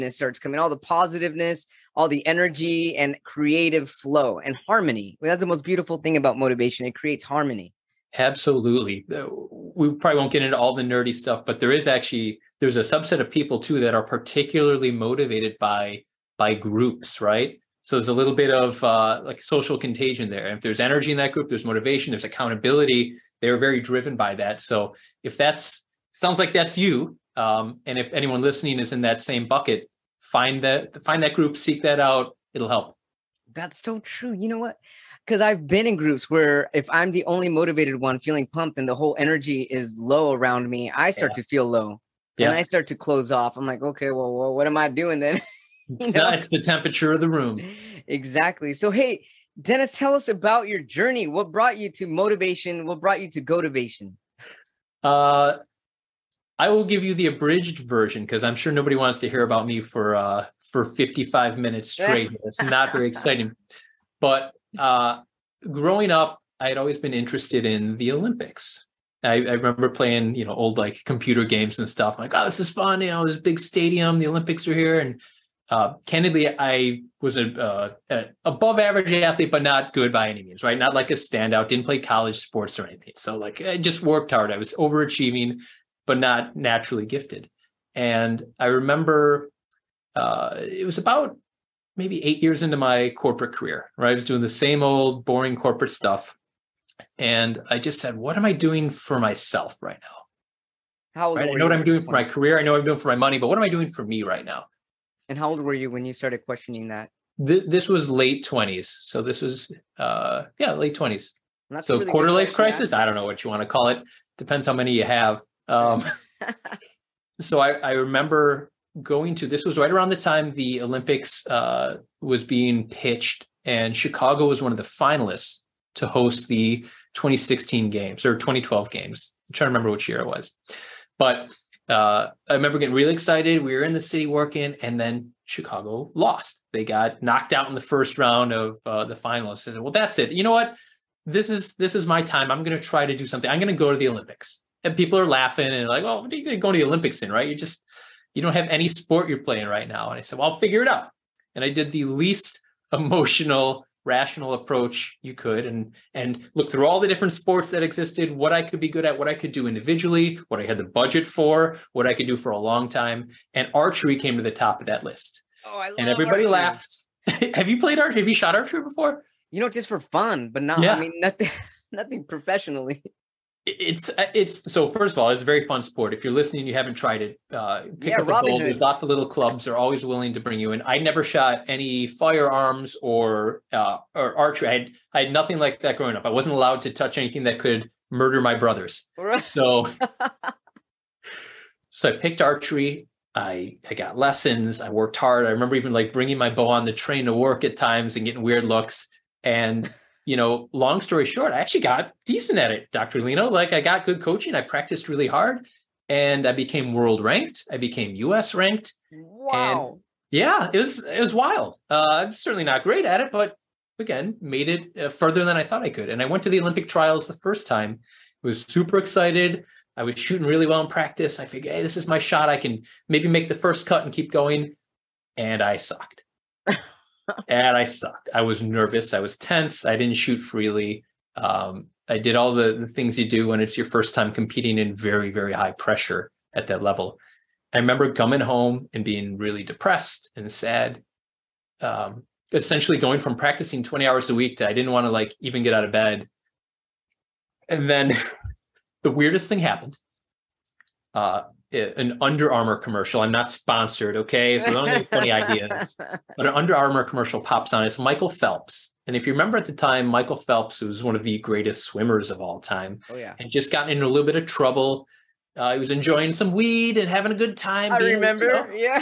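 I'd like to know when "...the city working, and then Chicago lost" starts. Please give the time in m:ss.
2:13.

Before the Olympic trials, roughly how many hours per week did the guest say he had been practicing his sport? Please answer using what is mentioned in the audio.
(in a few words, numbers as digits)
20.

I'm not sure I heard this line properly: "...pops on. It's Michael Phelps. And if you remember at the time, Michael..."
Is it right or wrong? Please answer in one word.
right.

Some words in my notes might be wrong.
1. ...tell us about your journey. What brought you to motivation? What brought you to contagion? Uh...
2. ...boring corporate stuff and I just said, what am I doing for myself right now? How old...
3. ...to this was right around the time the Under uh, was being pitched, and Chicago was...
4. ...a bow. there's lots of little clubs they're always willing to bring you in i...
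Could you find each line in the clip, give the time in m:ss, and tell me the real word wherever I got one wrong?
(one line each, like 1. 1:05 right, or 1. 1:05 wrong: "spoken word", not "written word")
1. 0:49 wrong: "gotivation", not "contagion"
2. 1:35 right
3. 1:59 wrong: "Olympics", not "Under"
4. 2:58 right.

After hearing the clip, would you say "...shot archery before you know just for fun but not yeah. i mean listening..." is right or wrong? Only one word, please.
wrong.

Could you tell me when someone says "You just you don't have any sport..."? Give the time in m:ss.
2:27.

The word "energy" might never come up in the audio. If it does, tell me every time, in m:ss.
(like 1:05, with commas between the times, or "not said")
0:02, 0:20, 0:39.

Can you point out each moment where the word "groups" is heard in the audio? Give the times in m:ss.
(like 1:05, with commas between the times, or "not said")
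0:16, 0:21, 0:31, 0:35.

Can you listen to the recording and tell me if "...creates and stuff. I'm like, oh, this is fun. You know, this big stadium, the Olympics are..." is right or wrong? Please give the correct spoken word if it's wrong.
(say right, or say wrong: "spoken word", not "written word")
wrong: "games", not "creates".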